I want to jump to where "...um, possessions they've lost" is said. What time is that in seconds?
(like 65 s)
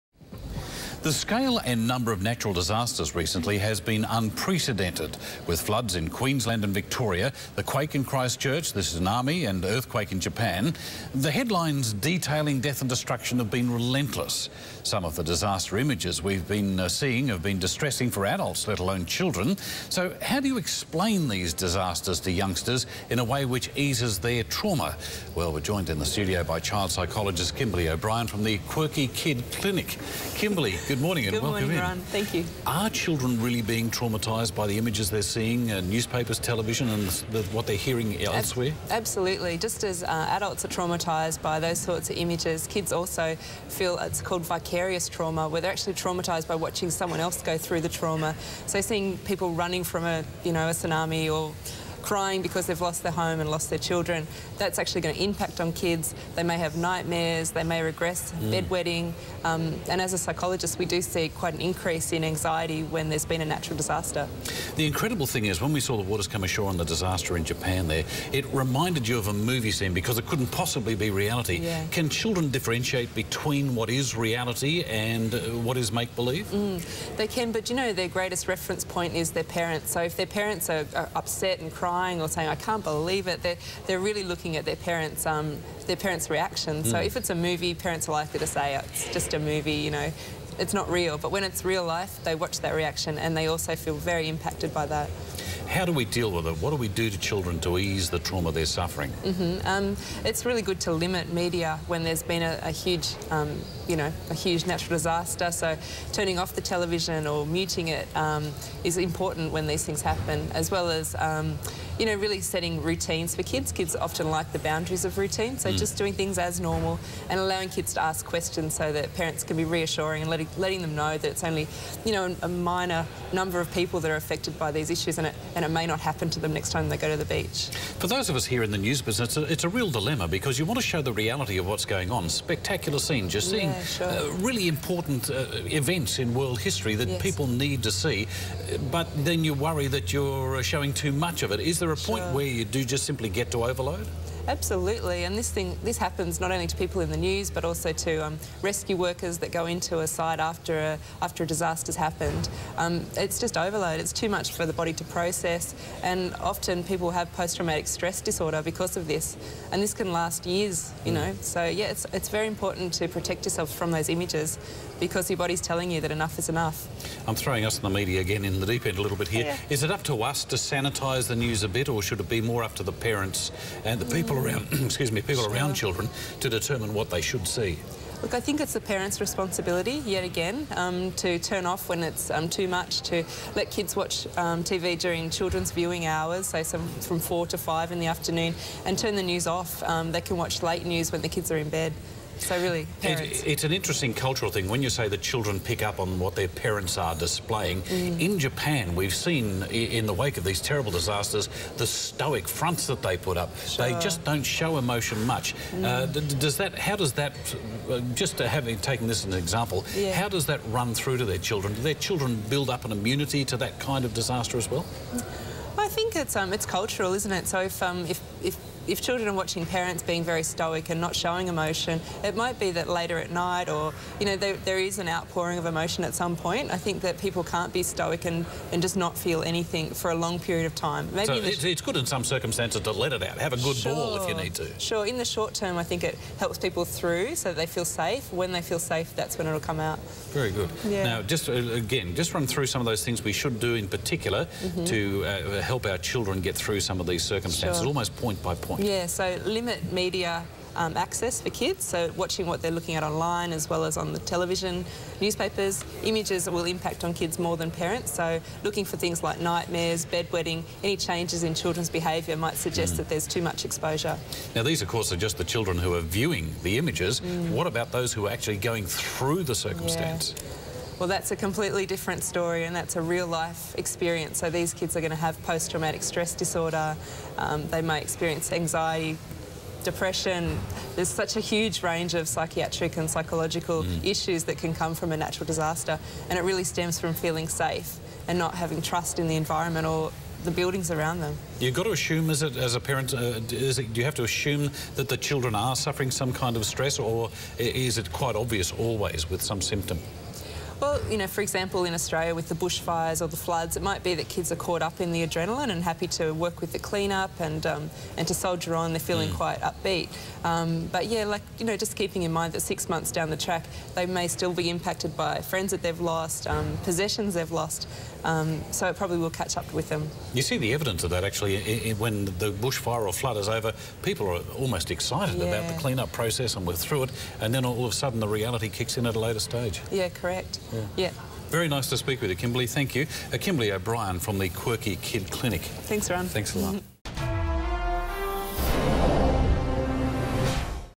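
316 s.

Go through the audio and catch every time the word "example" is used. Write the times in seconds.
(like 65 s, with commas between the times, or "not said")
209 s, 301 s.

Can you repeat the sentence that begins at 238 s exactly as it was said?
When they feel safe, that's when it'll come out.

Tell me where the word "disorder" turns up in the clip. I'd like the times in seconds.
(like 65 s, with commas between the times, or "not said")
158 s, 276 s.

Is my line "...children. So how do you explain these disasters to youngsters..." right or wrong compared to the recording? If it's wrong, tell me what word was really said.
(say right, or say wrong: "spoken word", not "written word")
right.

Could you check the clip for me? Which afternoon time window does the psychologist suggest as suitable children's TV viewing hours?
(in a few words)
4 to 5.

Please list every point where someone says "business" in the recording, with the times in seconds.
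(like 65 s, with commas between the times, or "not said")
129 s.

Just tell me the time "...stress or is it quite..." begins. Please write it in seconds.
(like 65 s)
296 s.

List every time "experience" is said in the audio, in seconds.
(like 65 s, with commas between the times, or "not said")
273 s, 278 s.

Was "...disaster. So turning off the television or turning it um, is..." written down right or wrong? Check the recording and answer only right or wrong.
wrong.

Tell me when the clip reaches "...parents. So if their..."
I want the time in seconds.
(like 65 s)
79 s.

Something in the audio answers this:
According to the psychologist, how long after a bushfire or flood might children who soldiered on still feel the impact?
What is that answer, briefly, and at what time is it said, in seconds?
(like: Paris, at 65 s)
6 months, at 312 s.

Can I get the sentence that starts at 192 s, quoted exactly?
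So really, it, it's an interesting cultural thing when you say the children pick up on what their parents are displaying.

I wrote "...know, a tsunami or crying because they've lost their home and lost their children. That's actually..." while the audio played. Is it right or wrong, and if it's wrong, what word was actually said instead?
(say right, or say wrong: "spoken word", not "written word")
right.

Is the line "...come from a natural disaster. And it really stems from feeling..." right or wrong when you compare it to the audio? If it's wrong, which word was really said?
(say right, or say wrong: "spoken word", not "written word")
right.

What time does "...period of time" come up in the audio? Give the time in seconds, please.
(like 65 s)
230 s.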